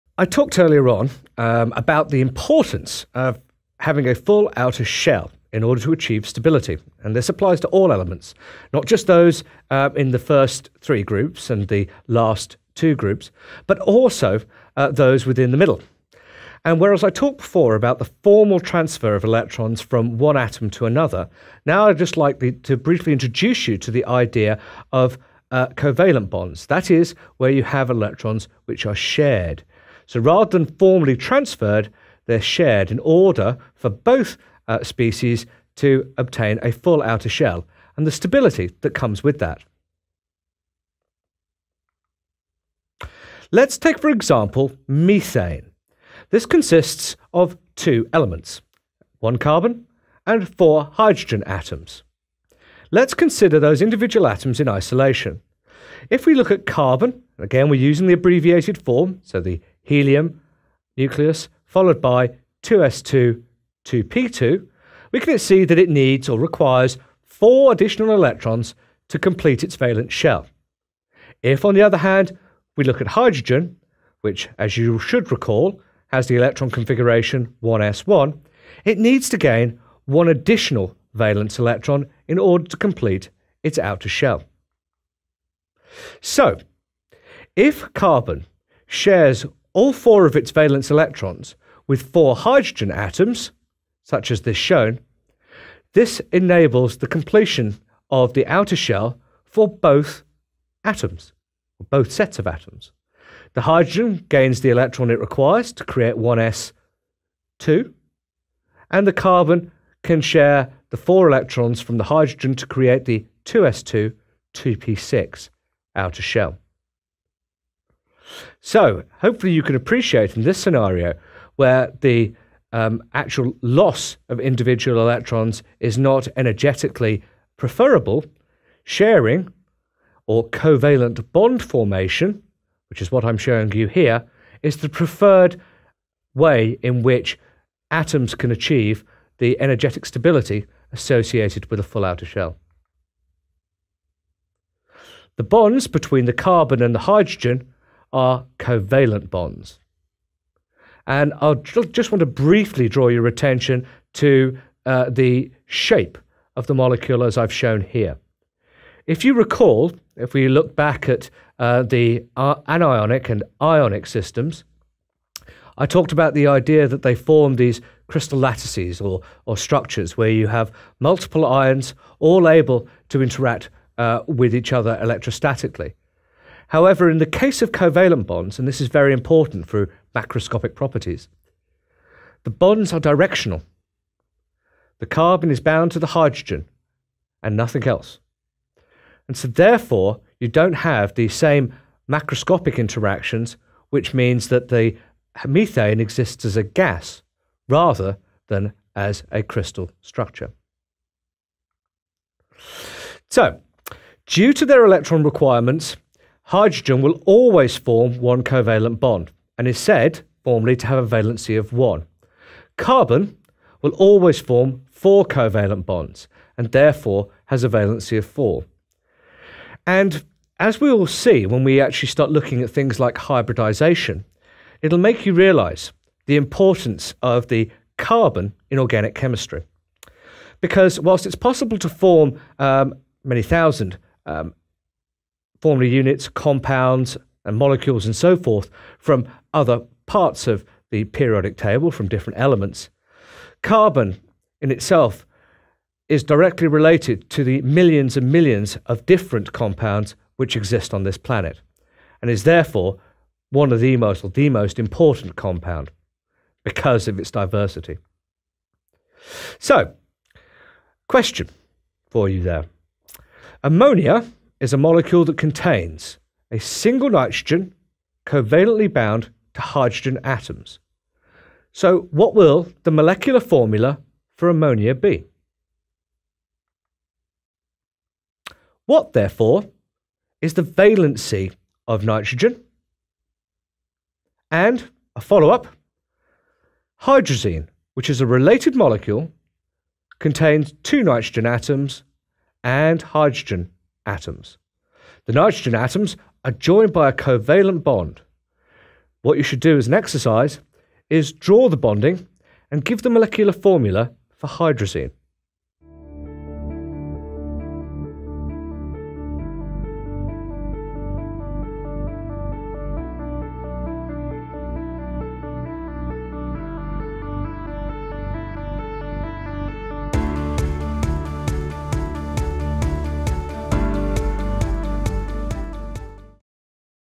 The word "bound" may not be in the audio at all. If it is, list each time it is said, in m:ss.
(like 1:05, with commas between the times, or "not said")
3:05, 4:28.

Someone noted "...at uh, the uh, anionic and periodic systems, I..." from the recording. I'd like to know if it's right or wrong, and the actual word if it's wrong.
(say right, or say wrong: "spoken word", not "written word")
wrong: "ionic", not "periodic".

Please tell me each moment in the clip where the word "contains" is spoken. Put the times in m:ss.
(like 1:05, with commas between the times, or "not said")
4:25, 4:50.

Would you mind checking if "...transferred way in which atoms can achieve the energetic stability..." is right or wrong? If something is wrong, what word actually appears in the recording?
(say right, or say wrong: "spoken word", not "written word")
wrong: "preferred", not "transferred".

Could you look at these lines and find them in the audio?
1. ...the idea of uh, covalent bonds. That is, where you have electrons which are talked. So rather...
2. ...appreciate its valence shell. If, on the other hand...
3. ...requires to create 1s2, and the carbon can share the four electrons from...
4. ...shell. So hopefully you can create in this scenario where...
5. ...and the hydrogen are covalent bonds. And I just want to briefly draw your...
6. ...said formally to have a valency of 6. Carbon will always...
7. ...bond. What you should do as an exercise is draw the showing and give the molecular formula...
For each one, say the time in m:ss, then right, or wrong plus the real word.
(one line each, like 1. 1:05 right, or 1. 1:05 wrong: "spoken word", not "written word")
1. 0:23 wrong: "shared", not "talked"
2. 1:09 wrong: "complete", not "appreciate"
3. 1:45 right
4. 1:56 wrong: "appreciate", not "create"
5. 2:26 right
6. 3:29 wrong: "1", not "6"
7. 4:57 wrong: "bonding", not "showing".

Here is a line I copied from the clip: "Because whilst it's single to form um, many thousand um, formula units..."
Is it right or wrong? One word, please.
wrong.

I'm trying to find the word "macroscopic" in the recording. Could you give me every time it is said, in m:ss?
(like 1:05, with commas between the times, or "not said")
3:00, 3:12.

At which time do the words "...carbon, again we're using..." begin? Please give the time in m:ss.
0:56.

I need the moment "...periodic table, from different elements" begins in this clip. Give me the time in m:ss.
4:01.